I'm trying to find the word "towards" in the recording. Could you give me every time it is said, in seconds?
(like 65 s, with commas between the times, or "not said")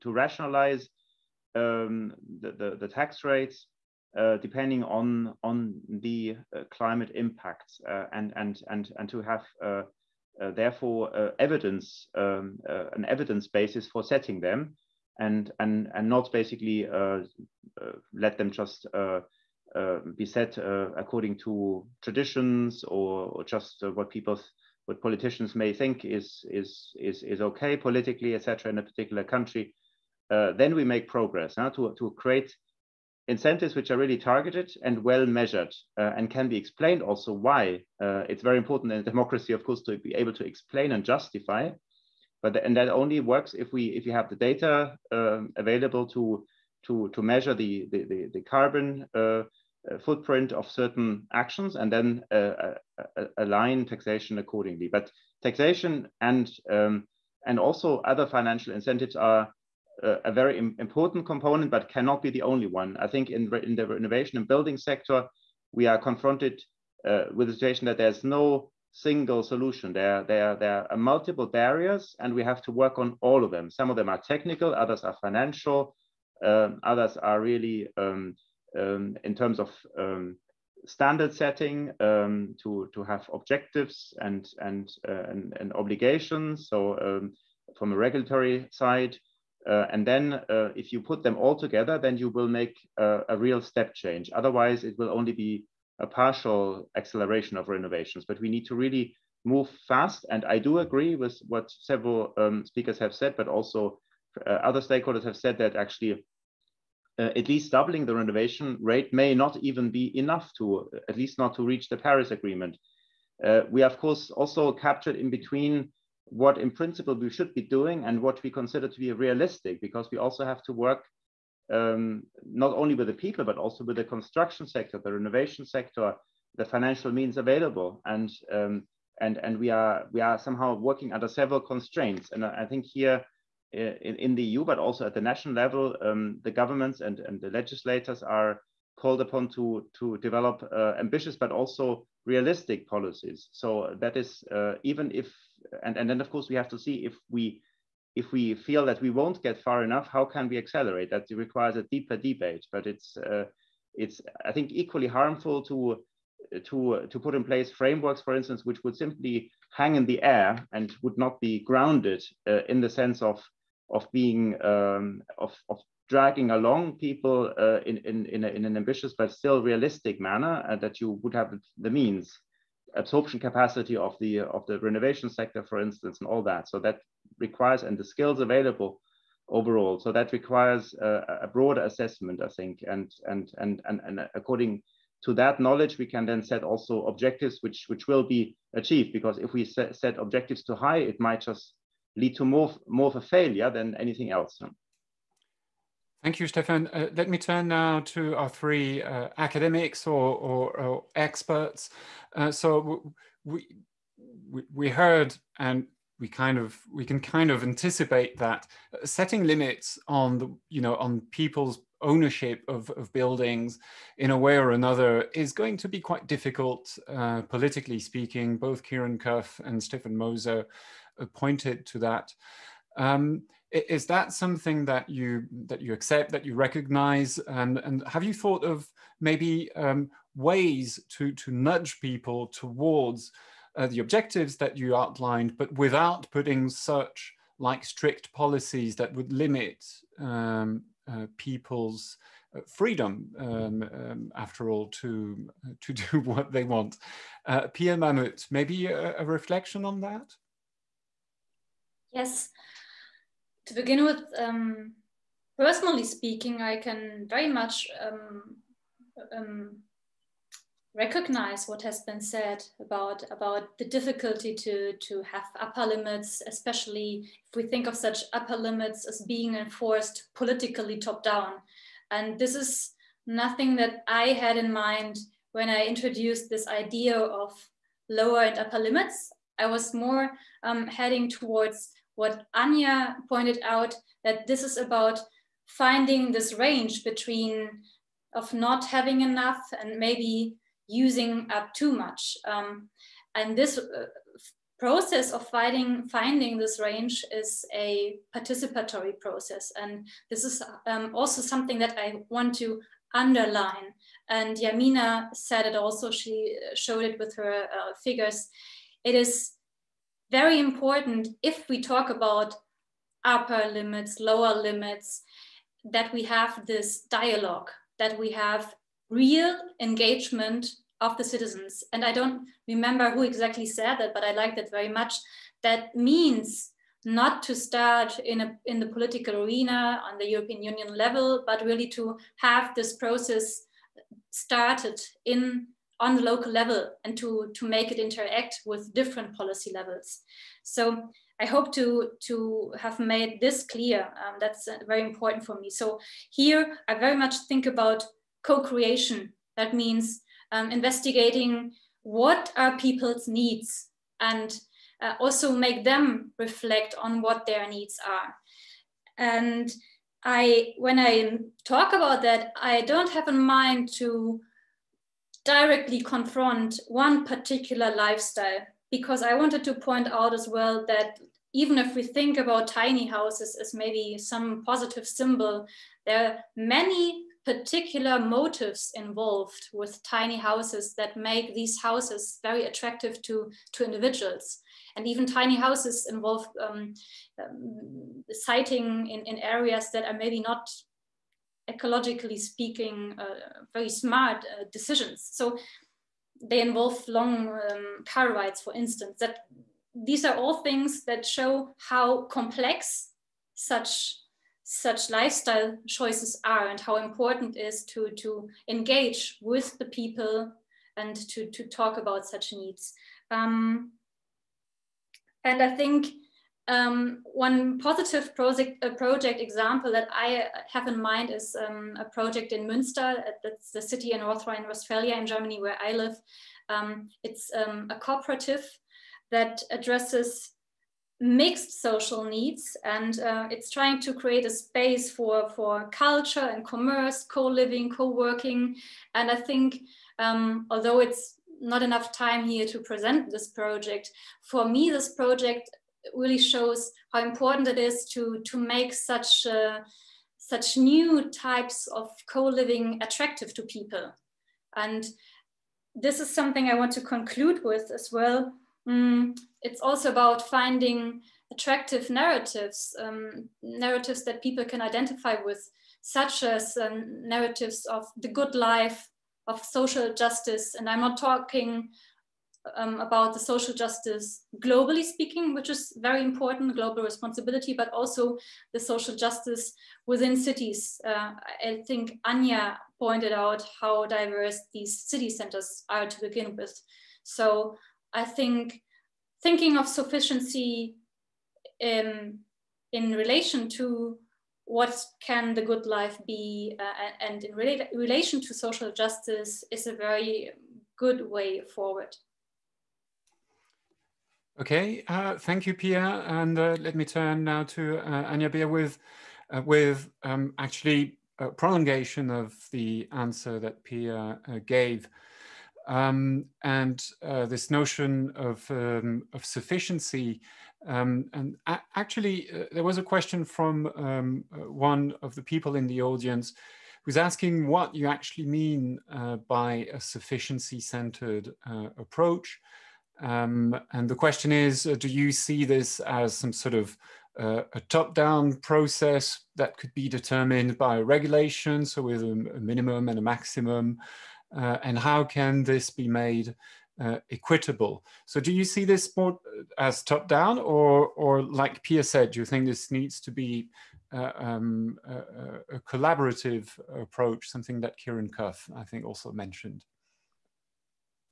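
232 s, 281 s.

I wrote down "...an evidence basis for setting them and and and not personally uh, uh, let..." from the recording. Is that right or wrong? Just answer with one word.
wrong.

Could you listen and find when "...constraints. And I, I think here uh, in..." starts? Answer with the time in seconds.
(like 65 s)
131 s.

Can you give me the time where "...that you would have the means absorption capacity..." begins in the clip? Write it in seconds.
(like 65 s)
170 s.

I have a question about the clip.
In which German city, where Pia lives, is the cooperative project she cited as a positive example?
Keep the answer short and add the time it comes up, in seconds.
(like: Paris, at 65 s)
Münster, at 422 s.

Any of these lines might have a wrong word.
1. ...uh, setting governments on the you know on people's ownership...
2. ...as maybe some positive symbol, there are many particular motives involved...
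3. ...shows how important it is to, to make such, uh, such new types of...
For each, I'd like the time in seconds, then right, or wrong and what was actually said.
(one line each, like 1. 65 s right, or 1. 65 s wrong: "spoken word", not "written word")
1. 208 s wrong: "limits", not "governments"
2. 373 s right
3. 446 s right.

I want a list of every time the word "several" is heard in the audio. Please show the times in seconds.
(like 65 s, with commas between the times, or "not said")
101 s, 131 s.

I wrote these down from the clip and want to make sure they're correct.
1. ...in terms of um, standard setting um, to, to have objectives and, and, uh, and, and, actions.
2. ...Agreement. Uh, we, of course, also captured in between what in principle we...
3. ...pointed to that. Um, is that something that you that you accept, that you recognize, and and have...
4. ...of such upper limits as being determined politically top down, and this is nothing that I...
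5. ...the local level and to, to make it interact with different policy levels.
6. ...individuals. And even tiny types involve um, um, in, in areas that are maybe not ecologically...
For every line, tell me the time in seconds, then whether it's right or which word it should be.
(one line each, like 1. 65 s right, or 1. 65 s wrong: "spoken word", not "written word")
1. 79 s wrong: "obligations", not "actions"
2. 112 s right
3. 221 s right
4. 267 s wrong: "enforced", not "determined"
5. 336 s right
6. 383 s wrong: "houses", not "types".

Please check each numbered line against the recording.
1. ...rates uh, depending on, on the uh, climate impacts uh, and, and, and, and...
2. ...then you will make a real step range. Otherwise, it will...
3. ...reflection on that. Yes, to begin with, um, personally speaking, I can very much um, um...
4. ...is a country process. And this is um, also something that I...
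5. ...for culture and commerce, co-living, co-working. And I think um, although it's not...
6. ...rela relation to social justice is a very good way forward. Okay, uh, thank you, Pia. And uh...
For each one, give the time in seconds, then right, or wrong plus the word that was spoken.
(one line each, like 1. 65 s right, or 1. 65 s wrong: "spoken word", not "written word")
1. 3 s right
2. 91 s wrong: "change", not "range"
3. 249 s right
4. 297 s wrong: "participatory", not "country"
5. 435 s right
6. 497 s right.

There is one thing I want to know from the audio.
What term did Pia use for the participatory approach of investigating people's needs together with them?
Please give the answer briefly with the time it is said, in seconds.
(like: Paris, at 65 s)
co-creation, at 348 s.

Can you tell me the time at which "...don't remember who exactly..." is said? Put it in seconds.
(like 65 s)
322 s.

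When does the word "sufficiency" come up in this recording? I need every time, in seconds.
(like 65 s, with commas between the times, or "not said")
489 s, 519 s, 530 s.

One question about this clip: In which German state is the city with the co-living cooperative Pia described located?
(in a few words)
North Rhine-Westphalia.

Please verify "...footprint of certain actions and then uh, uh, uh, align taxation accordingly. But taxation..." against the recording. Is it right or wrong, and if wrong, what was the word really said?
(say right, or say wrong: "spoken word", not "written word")
right.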